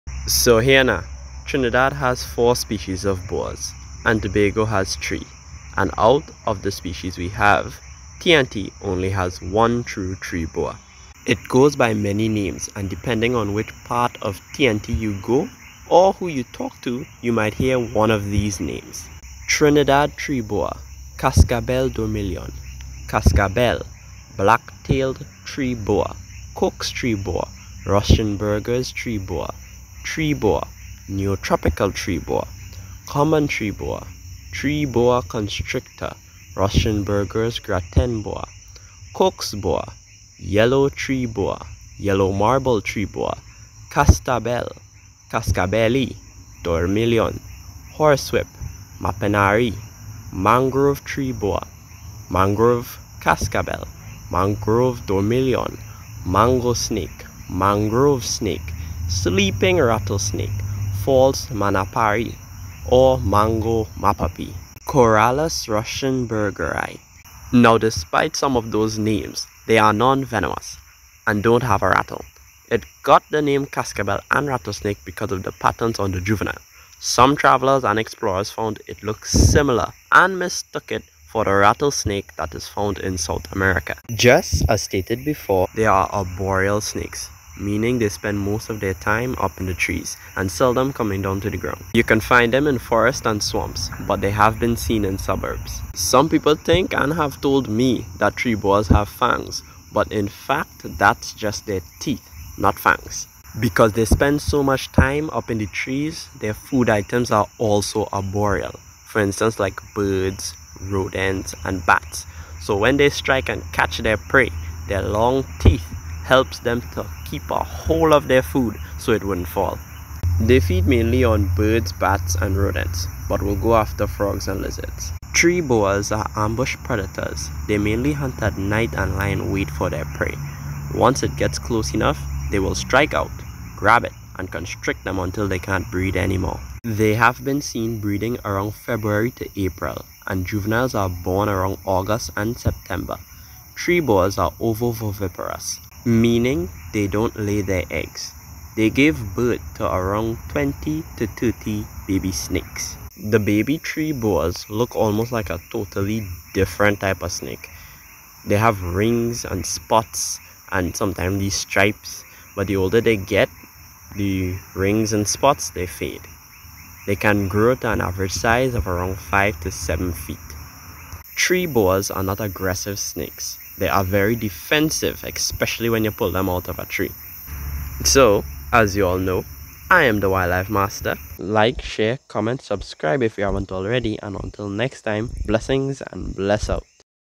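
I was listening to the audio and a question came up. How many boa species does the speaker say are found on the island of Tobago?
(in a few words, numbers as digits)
3.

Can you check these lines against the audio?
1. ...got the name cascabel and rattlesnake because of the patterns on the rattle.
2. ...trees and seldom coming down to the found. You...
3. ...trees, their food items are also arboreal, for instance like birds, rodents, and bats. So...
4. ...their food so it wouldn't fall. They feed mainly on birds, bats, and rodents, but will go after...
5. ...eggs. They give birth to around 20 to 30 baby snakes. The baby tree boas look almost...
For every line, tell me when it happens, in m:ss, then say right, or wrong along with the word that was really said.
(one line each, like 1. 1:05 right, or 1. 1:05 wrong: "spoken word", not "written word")
1. 1:13 wrong: "juvenile", not "rattle"
2. 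1:29 wrong: "ground", not "found"
3. 1:45 right
4. 1:58 right
5. 2:27 right.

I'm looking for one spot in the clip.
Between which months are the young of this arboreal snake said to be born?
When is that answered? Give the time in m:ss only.
2:21.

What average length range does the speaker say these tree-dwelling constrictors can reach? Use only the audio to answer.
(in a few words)
5 to 7 feet.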